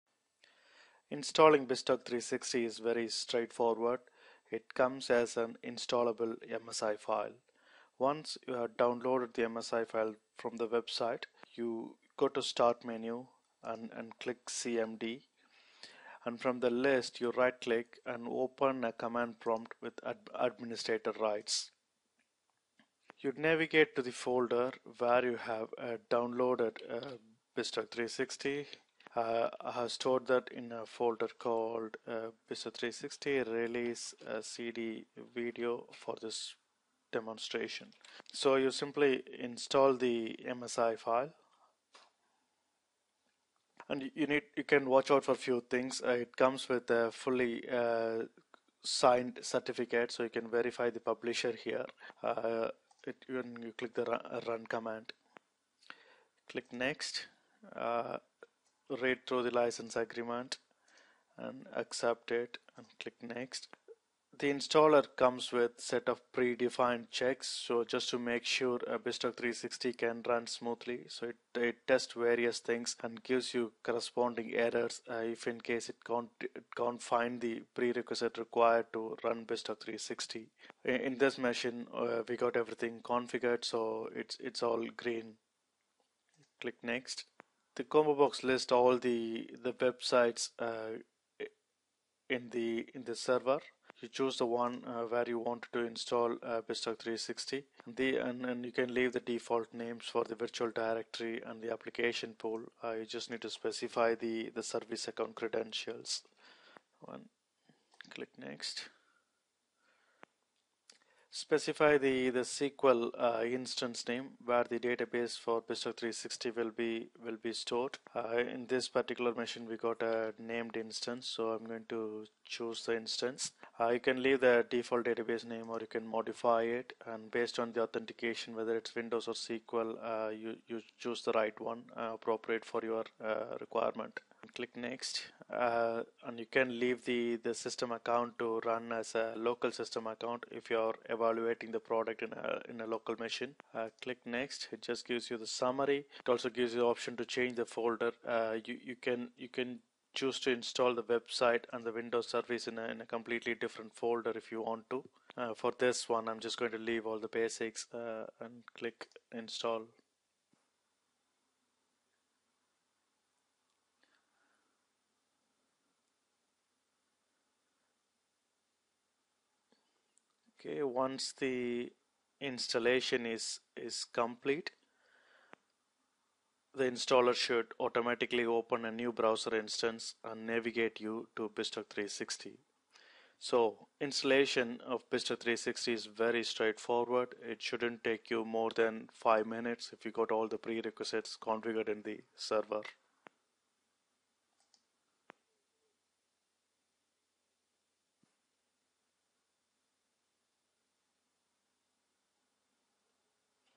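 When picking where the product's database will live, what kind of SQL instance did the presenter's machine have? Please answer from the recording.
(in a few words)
Named instance.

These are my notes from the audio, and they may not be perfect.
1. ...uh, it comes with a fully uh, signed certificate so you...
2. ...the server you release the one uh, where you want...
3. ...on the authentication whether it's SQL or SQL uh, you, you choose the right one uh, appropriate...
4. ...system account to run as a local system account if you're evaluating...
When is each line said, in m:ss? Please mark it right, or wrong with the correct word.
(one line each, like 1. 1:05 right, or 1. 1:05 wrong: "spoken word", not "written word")
1. 0:46 right
2. 1:33 wrong: "choose", not "release"
3. 2:07 wrong: "Windows", not "SQL"
4. 2:17 right.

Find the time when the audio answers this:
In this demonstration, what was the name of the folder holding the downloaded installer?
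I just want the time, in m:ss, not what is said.
0:32.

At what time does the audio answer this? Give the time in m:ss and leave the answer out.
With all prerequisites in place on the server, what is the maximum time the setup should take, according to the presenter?
3:09.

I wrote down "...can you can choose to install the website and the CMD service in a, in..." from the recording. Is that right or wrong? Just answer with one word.
wrong.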